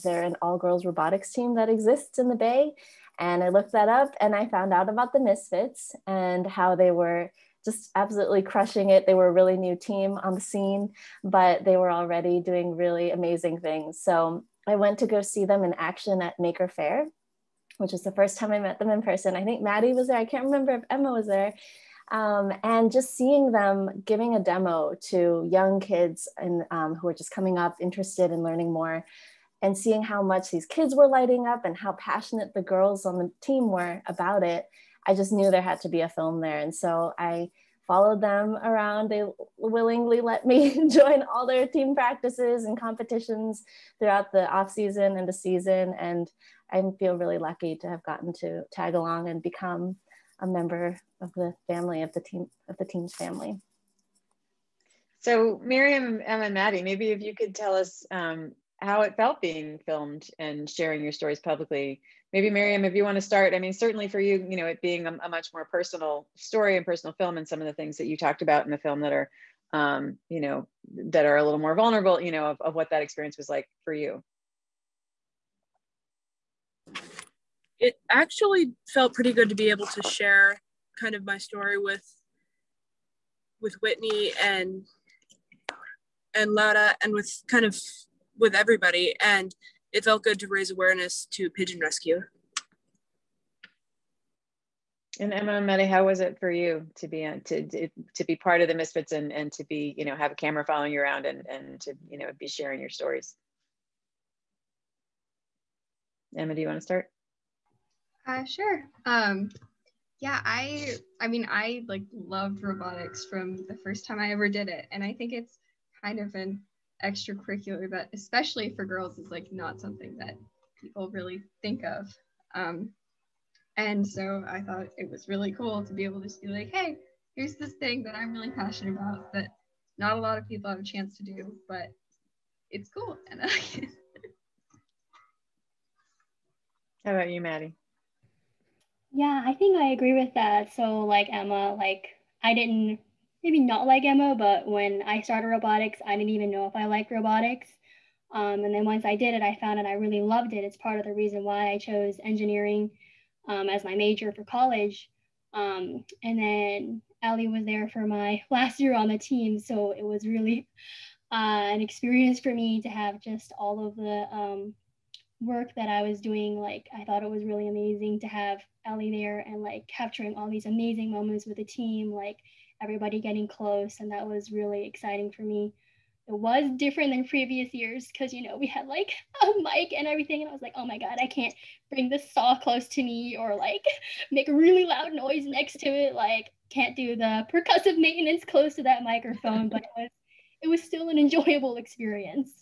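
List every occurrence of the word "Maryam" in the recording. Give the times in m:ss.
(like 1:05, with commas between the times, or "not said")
0:55, 1:02.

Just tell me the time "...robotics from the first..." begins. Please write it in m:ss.
1:52.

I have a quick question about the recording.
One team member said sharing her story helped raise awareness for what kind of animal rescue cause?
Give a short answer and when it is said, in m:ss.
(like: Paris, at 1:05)
Pigeon rescue, at 1:31.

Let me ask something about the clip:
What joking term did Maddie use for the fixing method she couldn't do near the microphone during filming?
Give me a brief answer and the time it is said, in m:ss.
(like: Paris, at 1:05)
Percussive maintenance, at 3:07.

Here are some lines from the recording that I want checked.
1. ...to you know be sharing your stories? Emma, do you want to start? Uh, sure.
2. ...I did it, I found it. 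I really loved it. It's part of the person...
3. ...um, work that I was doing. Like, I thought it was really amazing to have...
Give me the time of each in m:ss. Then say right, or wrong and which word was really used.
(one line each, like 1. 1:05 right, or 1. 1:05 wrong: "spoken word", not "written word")
1. 1:41 right
2. 2:29 wrong: "reason", not "person"
3. 2:44 right.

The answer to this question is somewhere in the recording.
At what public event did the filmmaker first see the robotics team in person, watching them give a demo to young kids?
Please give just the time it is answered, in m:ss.
0:16.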